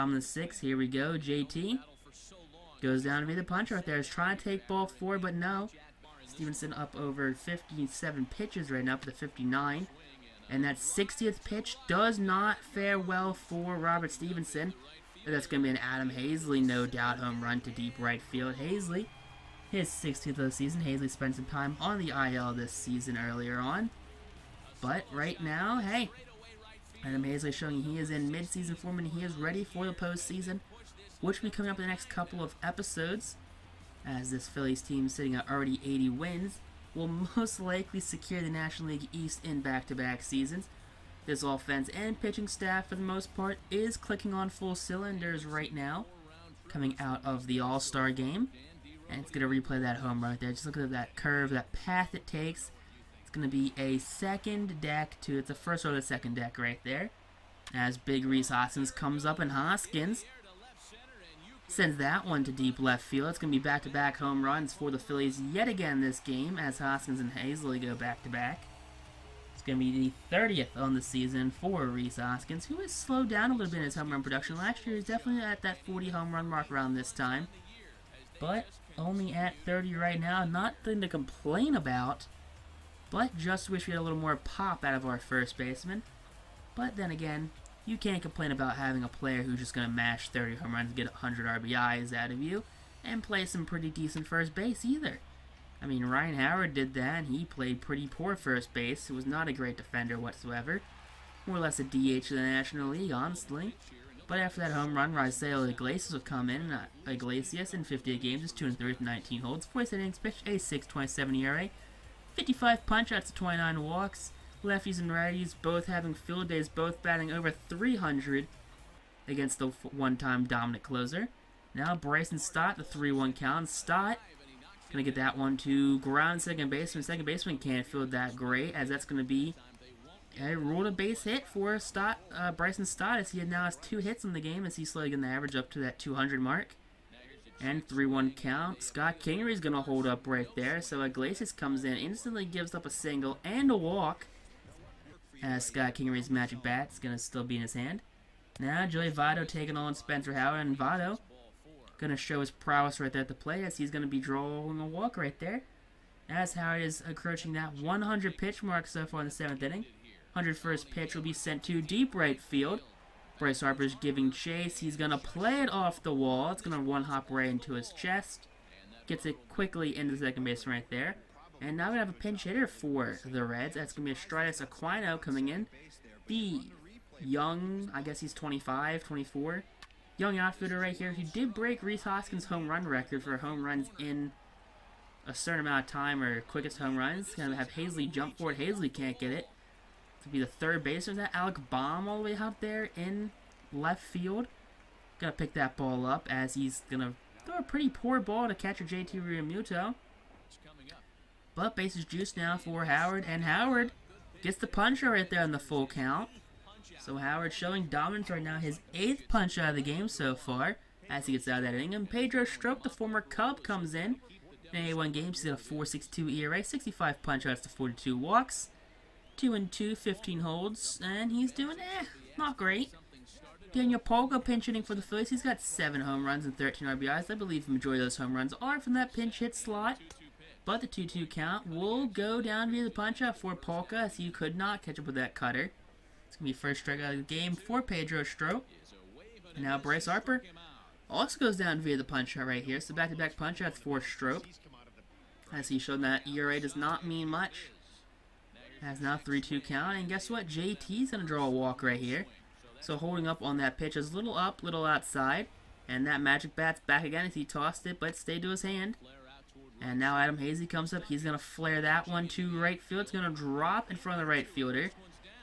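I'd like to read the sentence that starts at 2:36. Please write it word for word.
As Howard is approaching that 100 pitch mark so far in the seventh inning.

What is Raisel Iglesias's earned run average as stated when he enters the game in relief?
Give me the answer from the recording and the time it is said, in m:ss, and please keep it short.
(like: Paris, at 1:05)
6.27, at 1:50.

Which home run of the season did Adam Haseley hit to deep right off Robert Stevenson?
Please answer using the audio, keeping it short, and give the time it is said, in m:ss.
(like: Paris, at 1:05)
16th, at 0:19.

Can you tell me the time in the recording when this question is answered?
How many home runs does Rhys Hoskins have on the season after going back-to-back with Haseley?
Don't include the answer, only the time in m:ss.
1:10.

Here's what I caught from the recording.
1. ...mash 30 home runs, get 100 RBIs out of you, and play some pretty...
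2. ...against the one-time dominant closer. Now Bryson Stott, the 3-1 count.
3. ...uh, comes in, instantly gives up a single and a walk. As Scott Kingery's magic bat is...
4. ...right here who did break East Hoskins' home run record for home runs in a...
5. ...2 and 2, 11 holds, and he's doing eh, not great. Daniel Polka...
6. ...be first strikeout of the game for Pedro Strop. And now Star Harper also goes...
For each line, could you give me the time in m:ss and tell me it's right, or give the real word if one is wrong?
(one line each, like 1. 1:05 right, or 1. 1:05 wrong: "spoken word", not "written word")
1. 1:29 right
2. 1:59 right
3. 2:21 right
4. 3:00 wrong: "Rhys", not "East"
5. 3:39 wrong: "15", not "11"
6. 3:56 wrong: "Bryce", not "Star".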